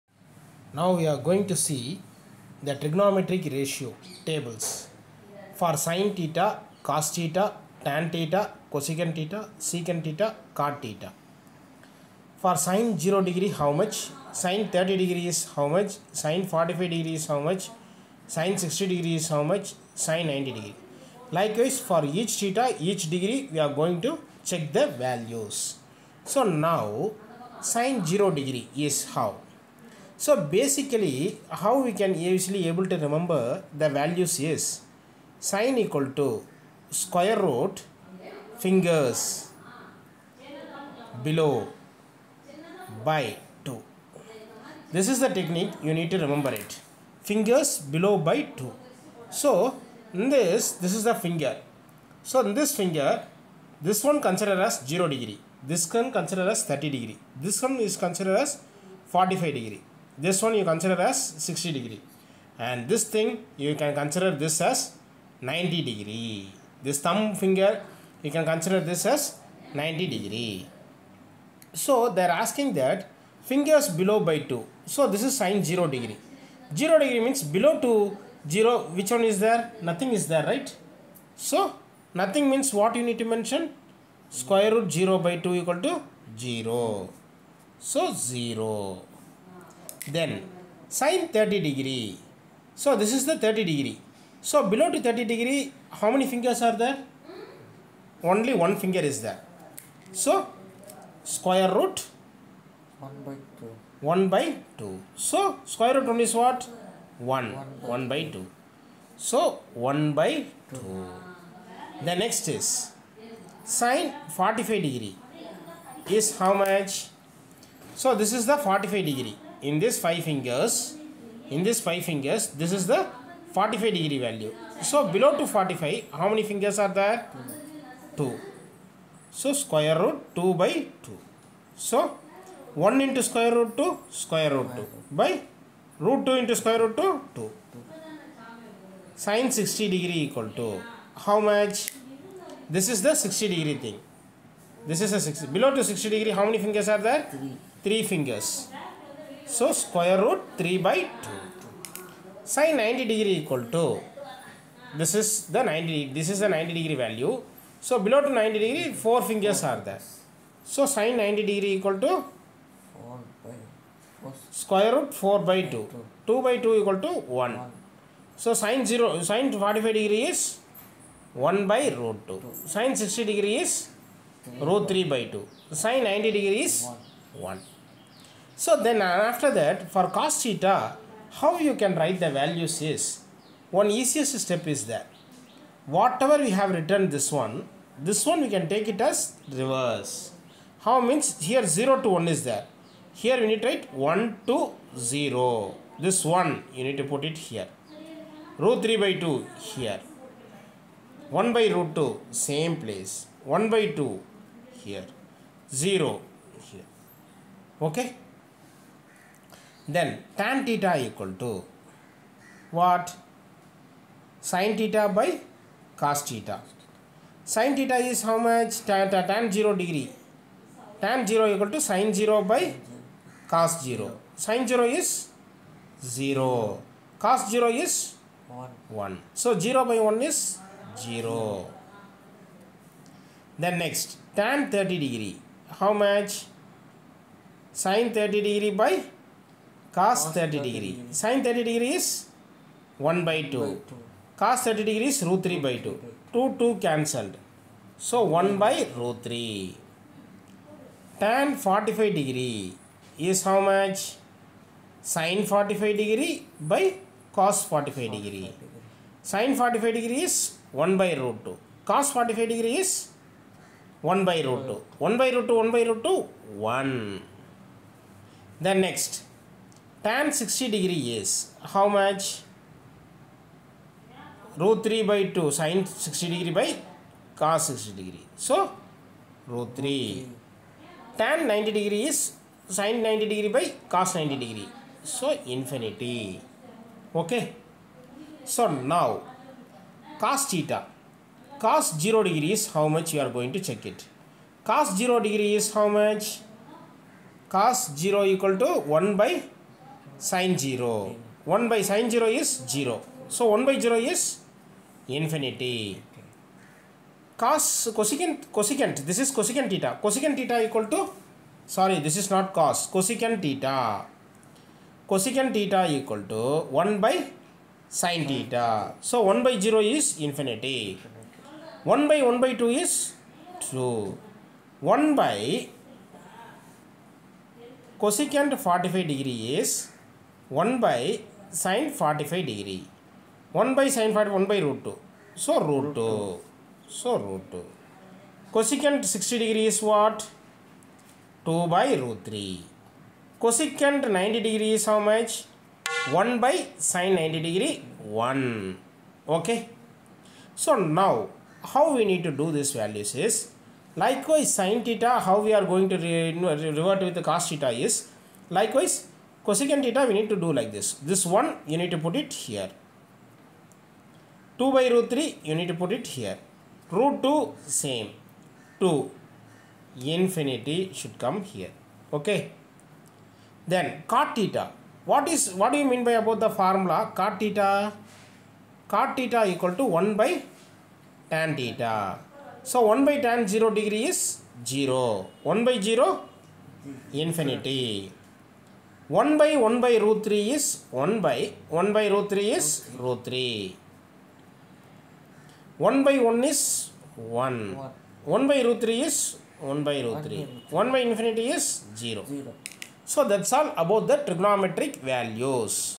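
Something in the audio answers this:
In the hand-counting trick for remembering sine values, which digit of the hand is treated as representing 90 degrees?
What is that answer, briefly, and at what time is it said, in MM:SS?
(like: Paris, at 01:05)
Thumb, at 01:07.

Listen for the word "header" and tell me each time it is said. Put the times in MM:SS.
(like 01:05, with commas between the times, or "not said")
not said.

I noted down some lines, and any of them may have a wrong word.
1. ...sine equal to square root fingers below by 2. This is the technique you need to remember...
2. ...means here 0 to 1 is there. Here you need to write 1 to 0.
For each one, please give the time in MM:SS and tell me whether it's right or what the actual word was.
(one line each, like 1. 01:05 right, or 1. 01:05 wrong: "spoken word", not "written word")
1. 00:35 right
2. 03:11 right.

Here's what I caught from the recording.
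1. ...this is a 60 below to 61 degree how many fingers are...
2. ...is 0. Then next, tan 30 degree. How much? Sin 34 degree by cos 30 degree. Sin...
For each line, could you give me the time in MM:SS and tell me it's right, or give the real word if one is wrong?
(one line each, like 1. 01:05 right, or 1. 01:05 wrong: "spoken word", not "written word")
1. 02:24 wrong: "60", not "61"
2. 03:50 wrong: "30", not "34".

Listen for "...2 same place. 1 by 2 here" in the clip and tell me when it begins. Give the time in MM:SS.
03:21.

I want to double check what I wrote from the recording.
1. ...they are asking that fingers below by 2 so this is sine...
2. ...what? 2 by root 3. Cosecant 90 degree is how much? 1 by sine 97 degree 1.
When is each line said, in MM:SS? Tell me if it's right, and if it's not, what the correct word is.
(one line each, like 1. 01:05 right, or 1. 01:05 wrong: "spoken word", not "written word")
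1. 01:12 right
2. 05:39 wrong: "90", not "97".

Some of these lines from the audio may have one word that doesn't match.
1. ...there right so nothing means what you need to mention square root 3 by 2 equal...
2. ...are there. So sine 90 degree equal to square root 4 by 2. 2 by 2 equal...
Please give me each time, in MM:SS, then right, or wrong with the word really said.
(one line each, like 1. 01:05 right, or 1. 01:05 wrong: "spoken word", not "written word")
1. 01:20 wrong: "0", not "3"
2. 02:39 right.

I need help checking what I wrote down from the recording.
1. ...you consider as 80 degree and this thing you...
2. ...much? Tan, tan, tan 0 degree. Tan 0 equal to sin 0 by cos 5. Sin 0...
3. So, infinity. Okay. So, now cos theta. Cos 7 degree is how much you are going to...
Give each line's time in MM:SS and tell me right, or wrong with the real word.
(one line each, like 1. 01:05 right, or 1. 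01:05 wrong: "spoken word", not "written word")
1. 01:00 wrong: "60", not "80"
2. 03:38 wrong: "0", not "5"
3. 04:45 wrong: "0", not "7".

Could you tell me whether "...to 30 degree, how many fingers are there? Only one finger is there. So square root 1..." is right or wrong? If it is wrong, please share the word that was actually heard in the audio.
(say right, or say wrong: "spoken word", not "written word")
right.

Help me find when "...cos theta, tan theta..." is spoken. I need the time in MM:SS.
00:06.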